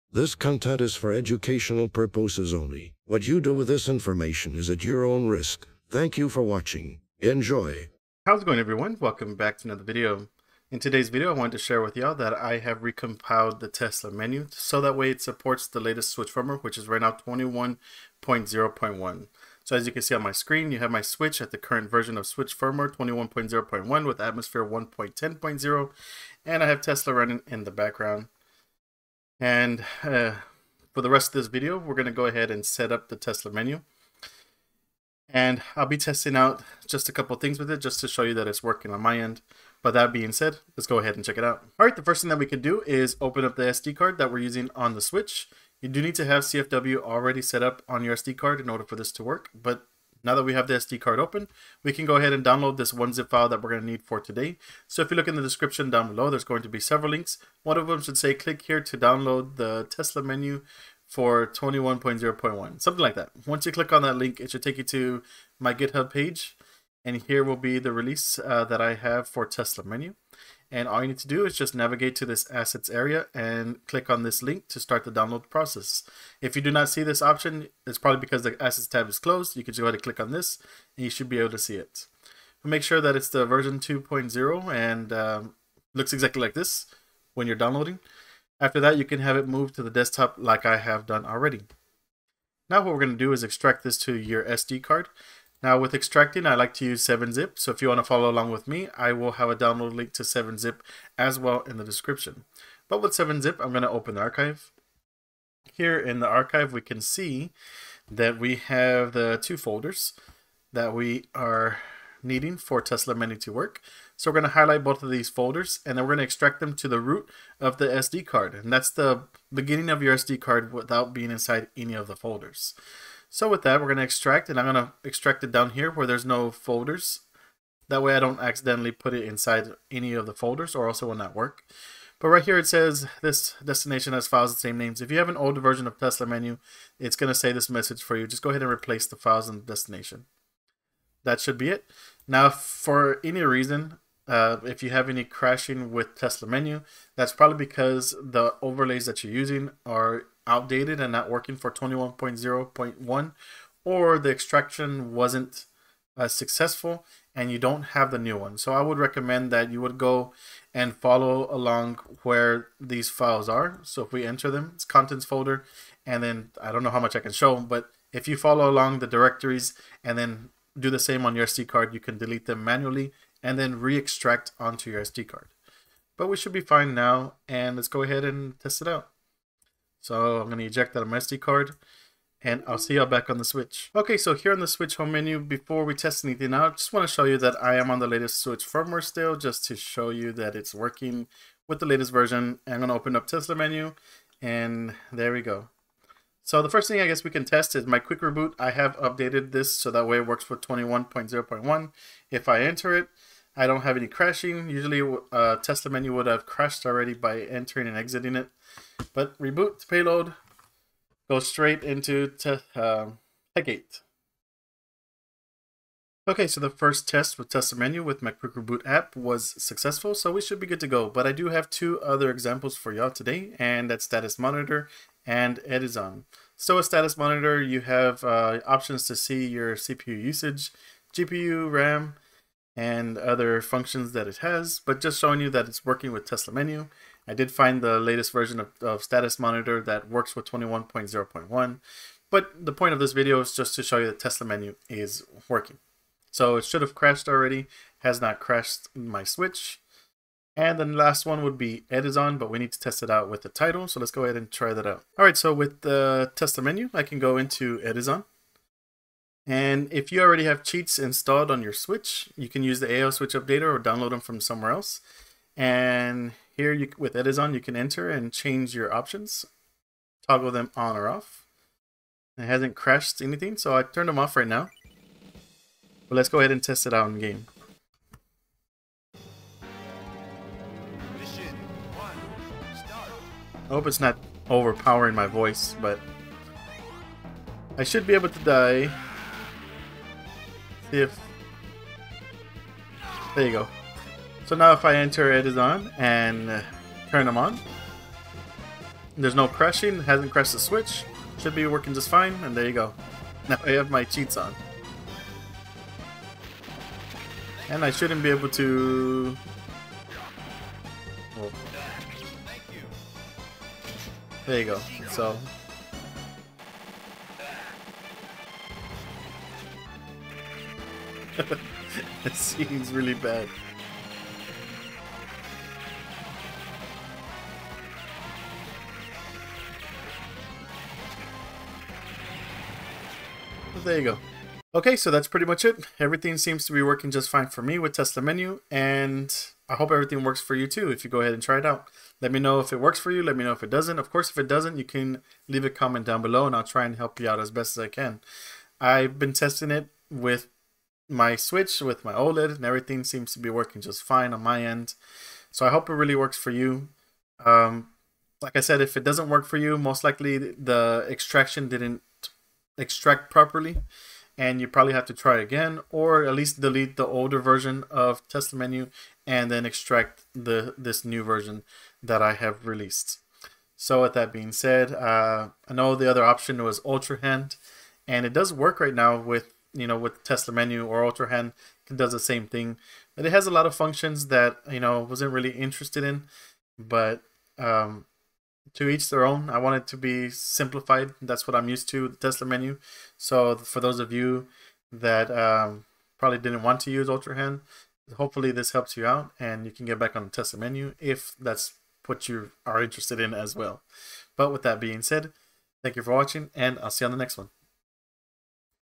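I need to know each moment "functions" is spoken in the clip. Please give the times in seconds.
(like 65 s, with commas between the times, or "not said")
233 s, 383 s.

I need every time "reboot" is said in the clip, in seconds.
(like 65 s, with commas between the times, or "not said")
198 s, 209 s, 218 s.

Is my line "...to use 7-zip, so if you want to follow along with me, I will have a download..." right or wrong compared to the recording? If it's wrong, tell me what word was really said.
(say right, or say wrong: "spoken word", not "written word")
right.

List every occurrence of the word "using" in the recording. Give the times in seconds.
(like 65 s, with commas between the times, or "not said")
44 s, 149 s.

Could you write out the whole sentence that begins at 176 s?
But we should be fine now, and let's go ahead and test it out.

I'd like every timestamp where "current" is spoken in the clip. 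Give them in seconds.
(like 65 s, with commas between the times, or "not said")
21 s.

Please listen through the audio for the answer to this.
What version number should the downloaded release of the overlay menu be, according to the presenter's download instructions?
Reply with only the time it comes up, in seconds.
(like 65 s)
83 s.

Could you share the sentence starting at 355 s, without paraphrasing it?
So I hope it really works for you.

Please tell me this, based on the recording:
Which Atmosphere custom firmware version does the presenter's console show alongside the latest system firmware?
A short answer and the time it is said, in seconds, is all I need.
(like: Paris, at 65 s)
1.10.0, at 24 s.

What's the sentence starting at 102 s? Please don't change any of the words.
But with 7-zip, I'm going to open the archive.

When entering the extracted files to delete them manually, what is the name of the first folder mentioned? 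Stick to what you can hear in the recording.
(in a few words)
contents.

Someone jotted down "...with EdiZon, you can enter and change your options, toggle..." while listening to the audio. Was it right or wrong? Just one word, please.
right.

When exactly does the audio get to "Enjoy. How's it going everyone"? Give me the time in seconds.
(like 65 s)
7 s.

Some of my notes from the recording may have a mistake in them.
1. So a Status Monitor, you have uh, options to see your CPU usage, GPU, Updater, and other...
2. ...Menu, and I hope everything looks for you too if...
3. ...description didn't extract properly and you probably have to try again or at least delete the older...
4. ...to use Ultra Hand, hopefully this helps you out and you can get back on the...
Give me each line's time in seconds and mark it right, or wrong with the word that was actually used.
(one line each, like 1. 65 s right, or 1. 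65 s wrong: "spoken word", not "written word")
1. 226 s wrong: "RAM", not "Updater"
2. 338 s wrong: "works", not "looks"
3. 361 s wrong: "extraction", not "description"
4. 396 s right.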